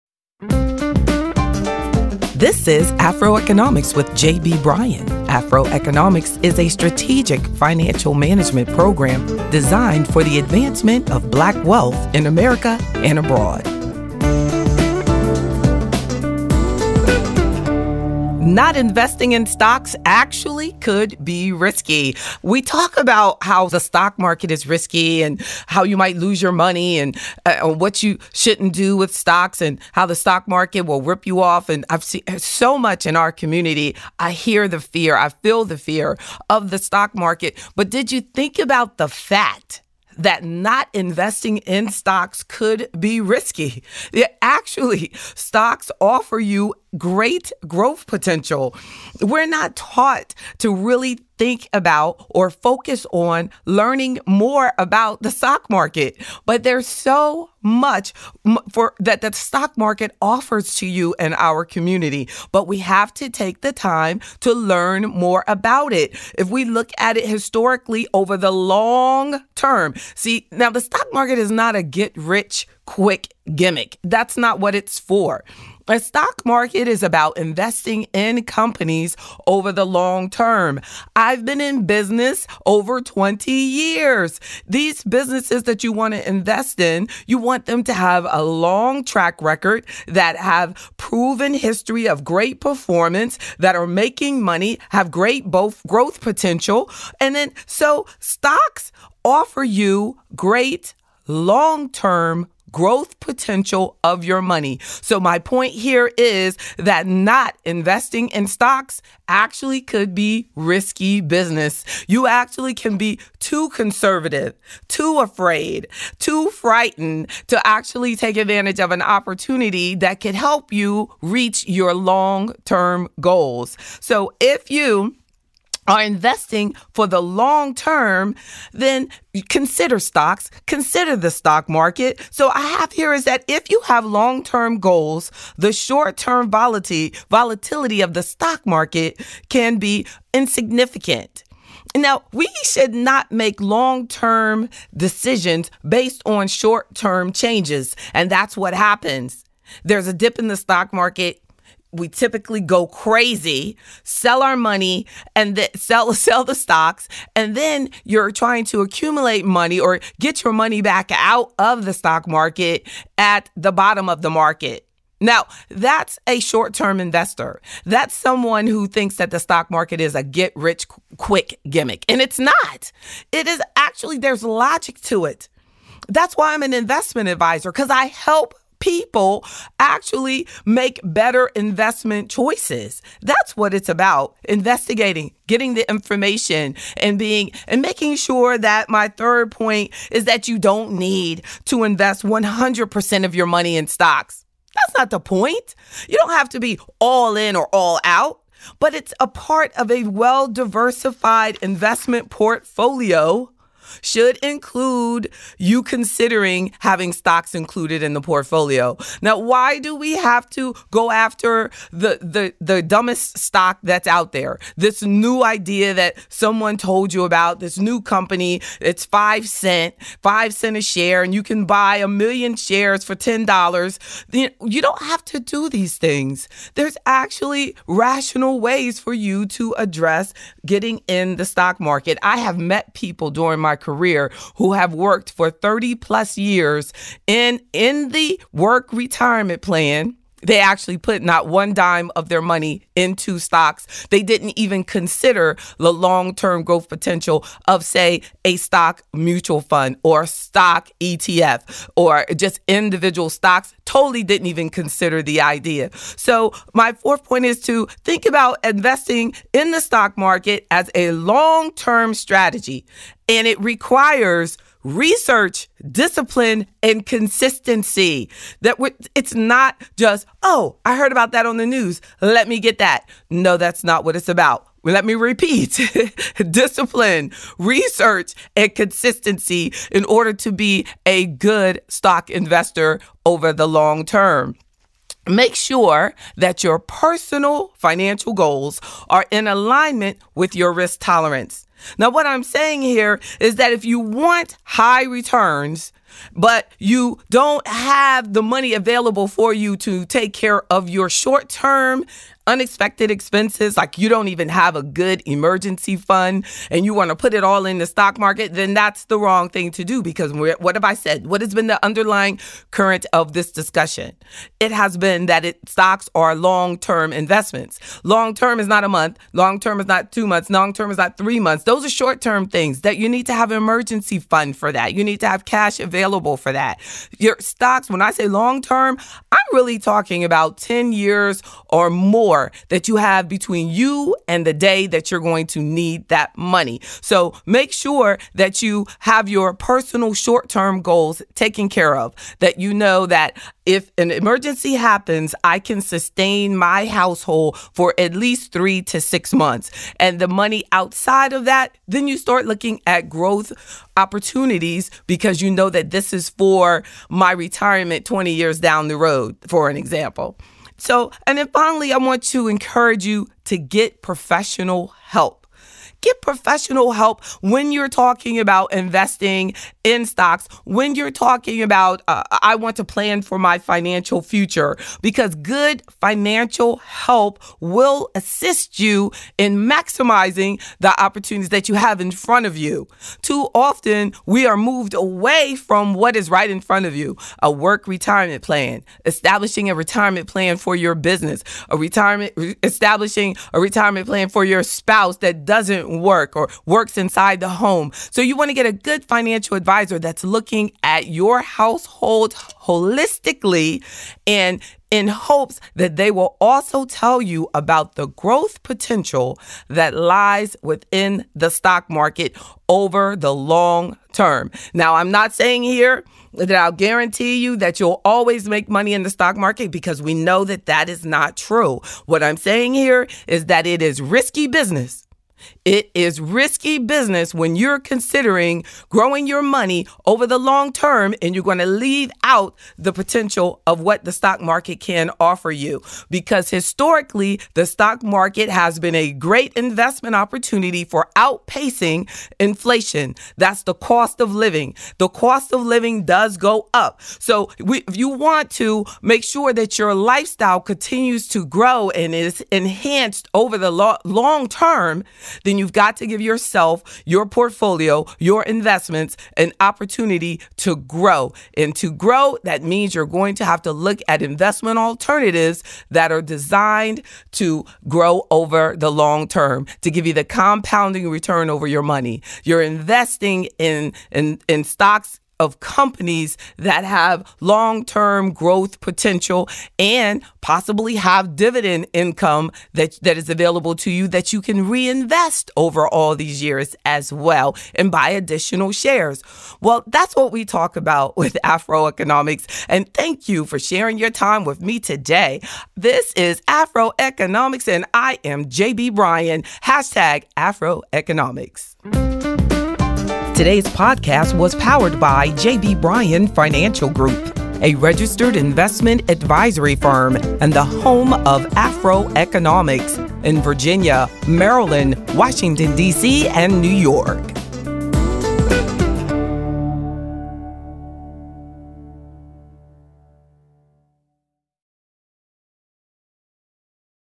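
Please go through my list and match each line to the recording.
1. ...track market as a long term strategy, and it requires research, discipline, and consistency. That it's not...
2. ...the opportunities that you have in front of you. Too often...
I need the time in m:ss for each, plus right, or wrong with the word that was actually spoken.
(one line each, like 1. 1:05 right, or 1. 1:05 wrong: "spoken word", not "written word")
1. 4:19 wrong: "stock", not "track"
2. 6:20 right.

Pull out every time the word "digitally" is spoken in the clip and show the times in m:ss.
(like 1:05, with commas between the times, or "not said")
not said.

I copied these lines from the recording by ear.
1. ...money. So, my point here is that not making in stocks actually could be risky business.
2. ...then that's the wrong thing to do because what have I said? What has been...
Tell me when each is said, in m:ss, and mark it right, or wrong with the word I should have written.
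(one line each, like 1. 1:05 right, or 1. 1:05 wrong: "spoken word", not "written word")
1. 1:44 wrong: "investing", not "making"
2. 5:08 right.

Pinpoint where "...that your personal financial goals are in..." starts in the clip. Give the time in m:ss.
4:46.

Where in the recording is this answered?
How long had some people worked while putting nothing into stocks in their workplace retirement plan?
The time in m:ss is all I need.
3:55.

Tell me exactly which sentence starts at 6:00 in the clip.
So, and then finally, I want to encourage you to get professional help.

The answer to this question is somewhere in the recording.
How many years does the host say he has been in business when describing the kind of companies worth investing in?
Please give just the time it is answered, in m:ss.
1:22.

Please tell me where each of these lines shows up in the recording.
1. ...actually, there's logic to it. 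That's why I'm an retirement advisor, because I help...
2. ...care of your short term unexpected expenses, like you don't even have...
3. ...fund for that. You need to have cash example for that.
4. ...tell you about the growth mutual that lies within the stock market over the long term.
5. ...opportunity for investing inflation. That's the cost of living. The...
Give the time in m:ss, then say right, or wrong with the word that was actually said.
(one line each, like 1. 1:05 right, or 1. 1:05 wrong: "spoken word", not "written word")
1. 2:53 wrong: "investment", not "retirement"
2. 5:00 right
3. 5:24 wrong: "available", not "example"
4. 6:46 wrong: "potential", not "mutual"
5. 7:20 wrong: "outpacing", not "investing".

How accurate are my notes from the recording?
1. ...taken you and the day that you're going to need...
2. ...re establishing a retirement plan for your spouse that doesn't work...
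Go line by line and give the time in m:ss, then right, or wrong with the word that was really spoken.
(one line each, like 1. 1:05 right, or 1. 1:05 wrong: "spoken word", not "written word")
1. 5:33 wrong: "between", not "taken"
2. 6:32 right.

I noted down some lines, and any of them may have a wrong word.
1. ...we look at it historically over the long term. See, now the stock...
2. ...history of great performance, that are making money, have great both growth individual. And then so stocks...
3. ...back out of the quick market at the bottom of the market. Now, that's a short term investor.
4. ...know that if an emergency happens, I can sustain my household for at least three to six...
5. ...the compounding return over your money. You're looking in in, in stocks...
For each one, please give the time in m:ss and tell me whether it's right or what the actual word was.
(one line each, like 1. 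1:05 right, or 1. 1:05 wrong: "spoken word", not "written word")
1. 1:06 right
2. 1:31 wrong: "potential", not "individual"
3. 2:40 wrong: "stock", not "quick"
4. 5:42 right
5. 7:50 wrong: "investing", not "looking".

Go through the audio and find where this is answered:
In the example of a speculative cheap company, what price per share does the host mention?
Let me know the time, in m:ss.
3:40.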